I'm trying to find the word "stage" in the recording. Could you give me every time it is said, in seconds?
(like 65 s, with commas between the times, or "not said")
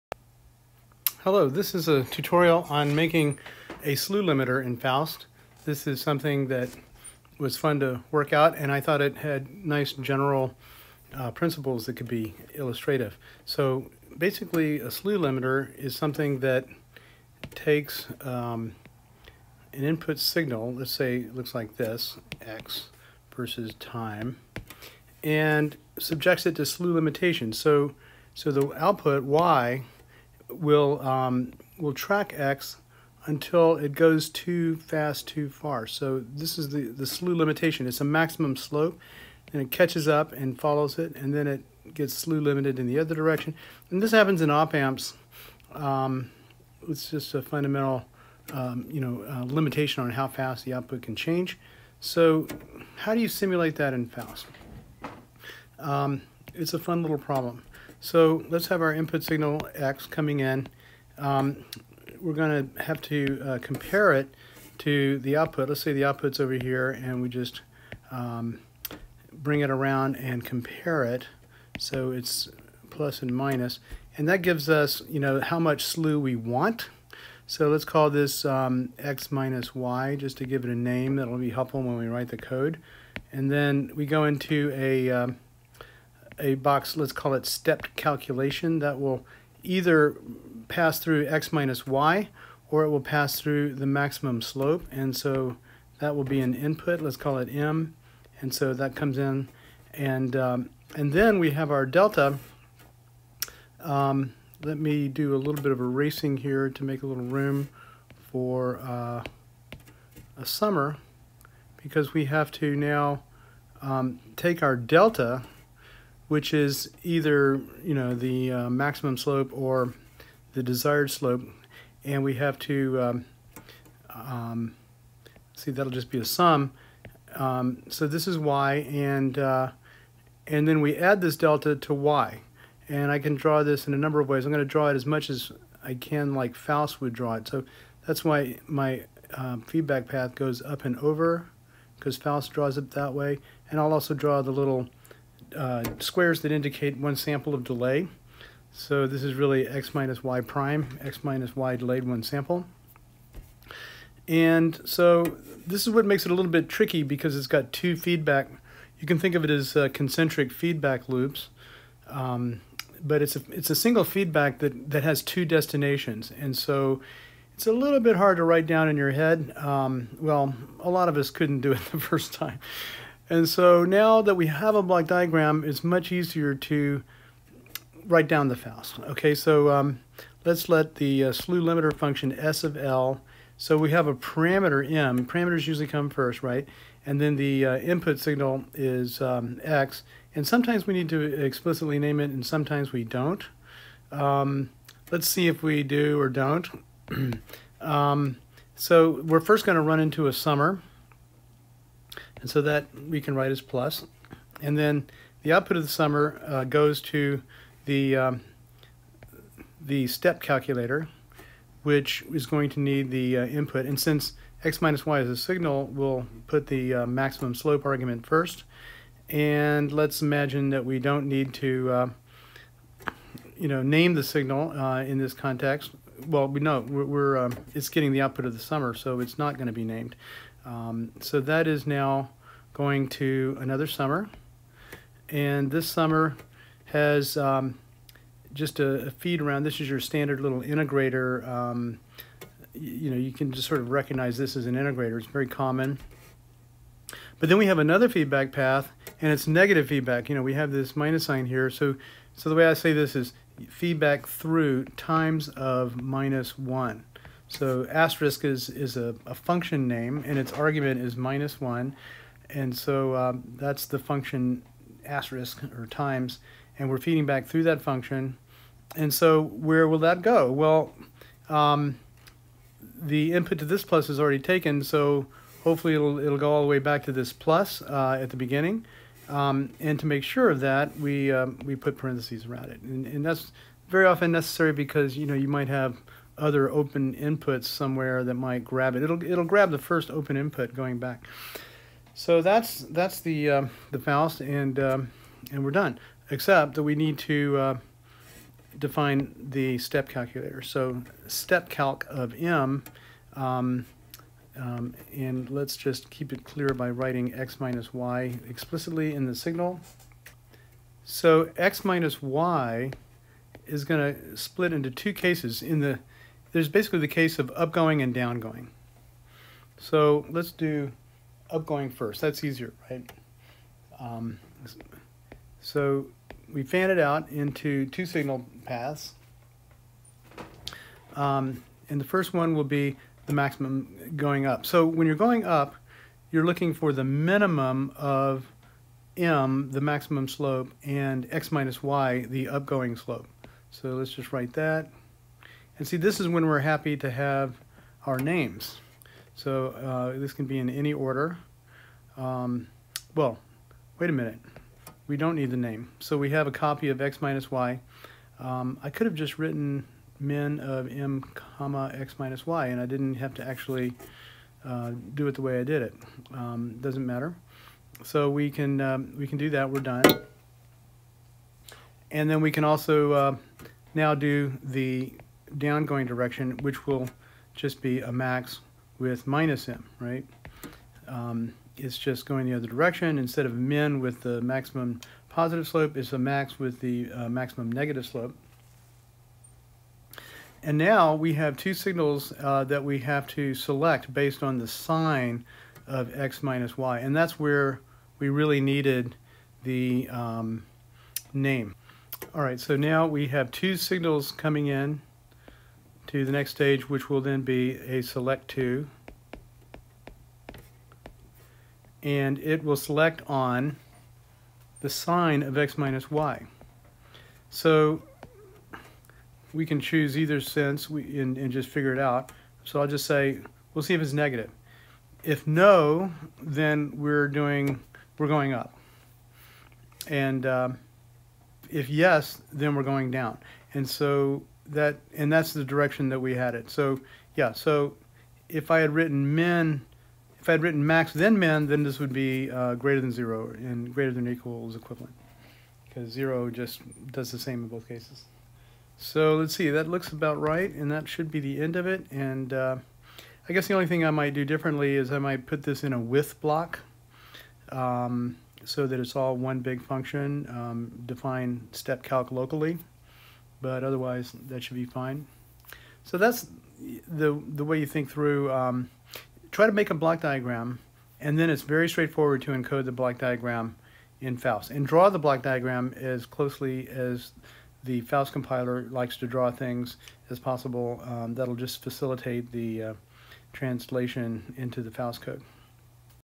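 406 s.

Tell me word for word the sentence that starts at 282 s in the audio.
And, and that's very often necessary because, you know, you might have other open inputs somewhere that might grab it.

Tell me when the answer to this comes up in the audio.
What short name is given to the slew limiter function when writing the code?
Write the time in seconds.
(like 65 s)
182 s.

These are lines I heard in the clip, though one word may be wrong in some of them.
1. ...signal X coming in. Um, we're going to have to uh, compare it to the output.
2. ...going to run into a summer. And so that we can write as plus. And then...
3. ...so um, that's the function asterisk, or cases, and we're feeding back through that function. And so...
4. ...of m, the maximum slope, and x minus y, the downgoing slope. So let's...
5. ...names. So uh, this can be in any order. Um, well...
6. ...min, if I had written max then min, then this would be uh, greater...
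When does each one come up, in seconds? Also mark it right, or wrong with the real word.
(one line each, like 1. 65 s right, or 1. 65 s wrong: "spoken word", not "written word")
1. 59 s right
2. 199 s right
3. 262 s wrong: "times", not "cases"
4. 337 s wrong: "upgoing", not "downgoing"
5. 348 s right
6. 439 s right.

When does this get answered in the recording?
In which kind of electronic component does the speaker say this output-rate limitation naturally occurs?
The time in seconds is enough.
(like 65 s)
44 s.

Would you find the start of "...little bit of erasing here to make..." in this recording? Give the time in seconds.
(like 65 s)
105 s.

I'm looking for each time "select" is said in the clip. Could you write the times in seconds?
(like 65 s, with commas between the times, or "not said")
393 s, 408 s, 412 s.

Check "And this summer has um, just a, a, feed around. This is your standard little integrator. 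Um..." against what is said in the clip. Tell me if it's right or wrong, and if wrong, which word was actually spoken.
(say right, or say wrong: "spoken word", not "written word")
right.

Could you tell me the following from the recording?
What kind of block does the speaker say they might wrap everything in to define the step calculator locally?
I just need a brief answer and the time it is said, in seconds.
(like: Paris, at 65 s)
A with block, at 455 s.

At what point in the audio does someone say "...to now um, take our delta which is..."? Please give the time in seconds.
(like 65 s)
112 s.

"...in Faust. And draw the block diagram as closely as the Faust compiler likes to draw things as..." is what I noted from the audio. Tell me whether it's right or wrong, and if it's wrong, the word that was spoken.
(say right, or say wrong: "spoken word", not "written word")
right.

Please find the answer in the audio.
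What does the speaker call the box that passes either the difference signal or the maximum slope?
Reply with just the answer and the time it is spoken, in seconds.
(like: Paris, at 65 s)
Stepped calculation, at 87 s.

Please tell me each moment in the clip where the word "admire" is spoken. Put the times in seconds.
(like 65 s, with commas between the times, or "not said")
not said.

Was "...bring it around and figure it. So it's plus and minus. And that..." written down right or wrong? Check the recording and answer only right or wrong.
wrong.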